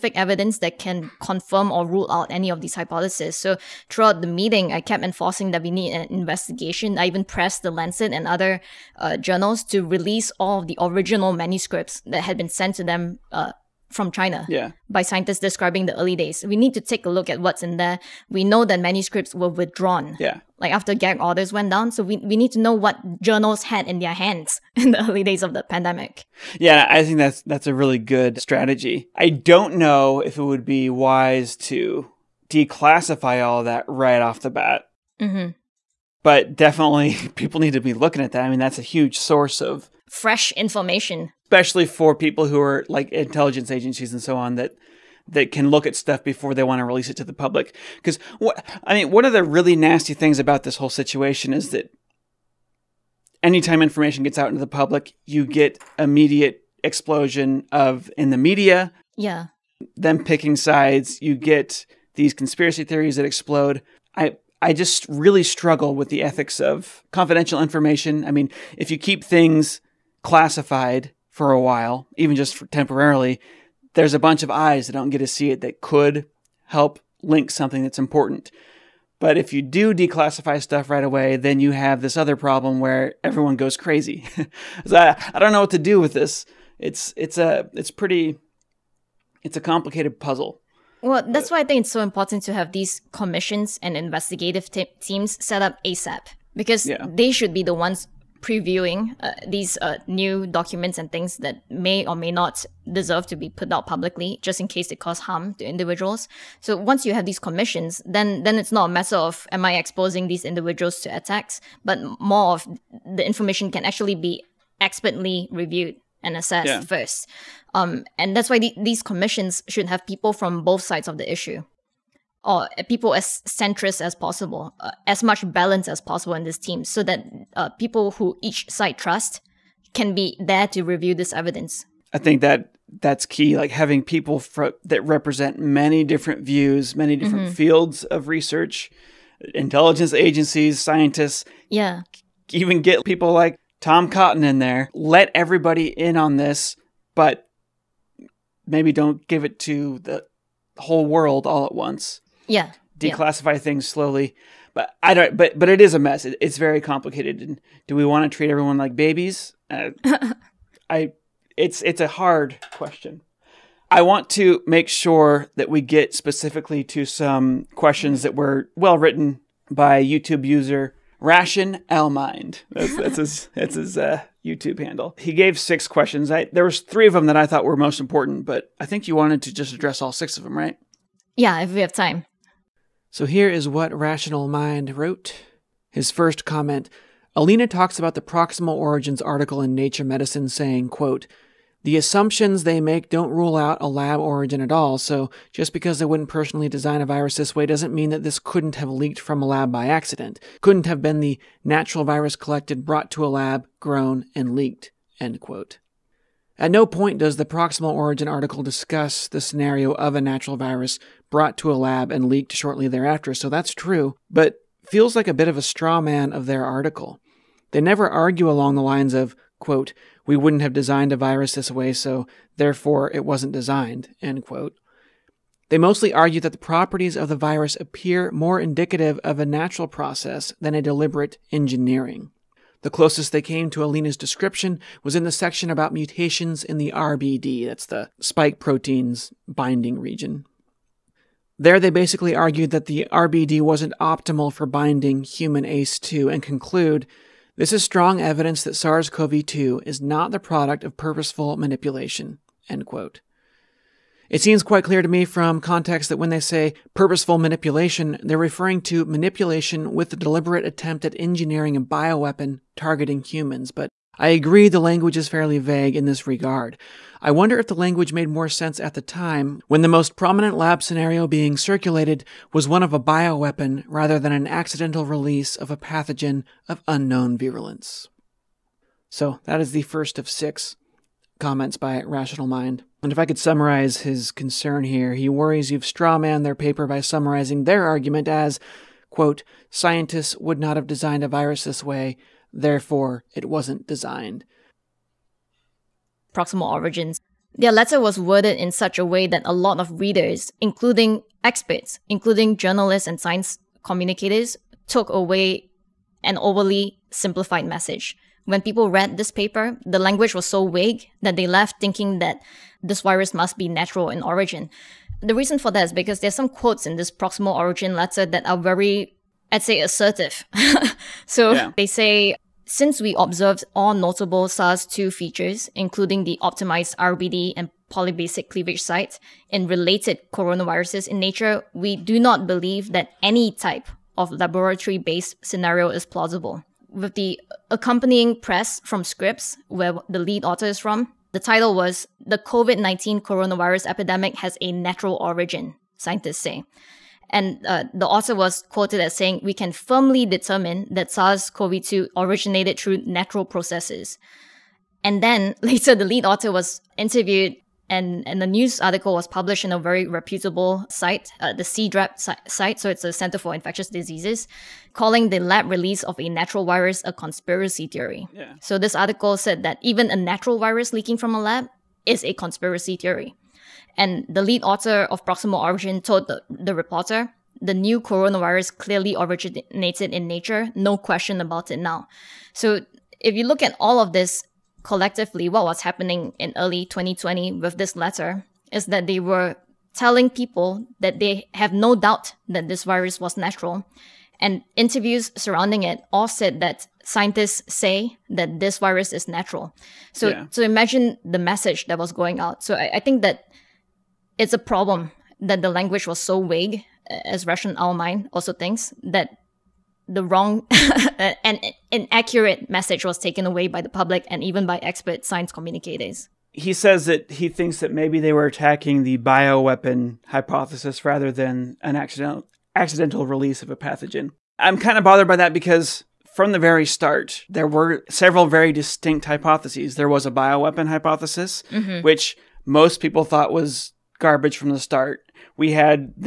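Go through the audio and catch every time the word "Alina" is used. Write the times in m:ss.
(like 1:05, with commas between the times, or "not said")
3:07, 3:53.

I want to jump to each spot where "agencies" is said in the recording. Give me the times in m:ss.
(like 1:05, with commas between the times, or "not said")
0:43, 2:20.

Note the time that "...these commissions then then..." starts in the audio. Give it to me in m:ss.
1:47.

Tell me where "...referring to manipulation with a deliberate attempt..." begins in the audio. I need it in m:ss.
4:18.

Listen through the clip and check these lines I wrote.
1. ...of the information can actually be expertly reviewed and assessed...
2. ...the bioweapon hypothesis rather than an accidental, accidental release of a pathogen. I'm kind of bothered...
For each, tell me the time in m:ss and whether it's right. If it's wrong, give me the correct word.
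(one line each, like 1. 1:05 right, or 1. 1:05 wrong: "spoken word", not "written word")
1. 1:52 right
2. 6:59 right.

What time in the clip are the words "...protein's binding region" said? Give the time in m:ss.
3:58.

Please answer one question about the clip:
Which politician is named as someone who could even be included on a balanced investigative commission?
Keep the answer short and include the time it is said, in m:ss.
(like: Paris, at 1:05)
Tom Cotton, at 2:23.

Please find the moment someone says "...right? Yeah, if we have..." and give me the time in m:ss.
3:00.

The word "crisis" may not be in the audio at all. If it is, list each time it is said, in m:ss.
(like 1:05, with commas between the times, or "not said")
not said.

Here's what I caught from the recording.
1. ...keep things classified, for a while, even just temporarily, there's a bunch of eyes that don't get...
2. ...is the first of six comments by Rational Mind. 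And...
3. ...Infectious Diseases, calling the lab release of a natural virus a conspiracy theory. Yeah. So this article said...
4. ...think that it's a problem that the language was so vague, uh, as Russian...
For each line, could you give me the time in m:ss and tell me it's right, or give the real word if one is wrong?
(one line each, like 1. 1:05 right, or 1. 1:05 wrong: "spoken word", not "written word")
1. 1:08 right
2. 4:39 right
3. 6:03 right
4. 6:42 right.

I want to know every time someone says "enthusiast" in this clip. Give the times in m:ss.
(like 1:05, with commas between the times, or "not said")
not said.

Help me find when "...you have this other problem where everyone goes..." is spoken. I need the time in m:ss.
1:21.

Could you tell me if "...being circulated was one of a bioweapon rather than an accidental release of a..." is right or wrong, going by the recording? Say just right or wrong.
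right.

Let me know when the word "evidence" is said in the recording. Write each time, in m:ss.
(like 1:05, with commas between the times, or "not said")
0:00, 2:11, 4:08.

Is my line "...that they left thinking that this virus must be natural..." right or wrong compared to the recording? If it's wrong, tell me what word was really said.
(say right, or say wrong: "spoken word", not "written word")
right.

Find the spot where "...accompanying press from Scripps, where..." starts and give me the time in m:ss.
5:37.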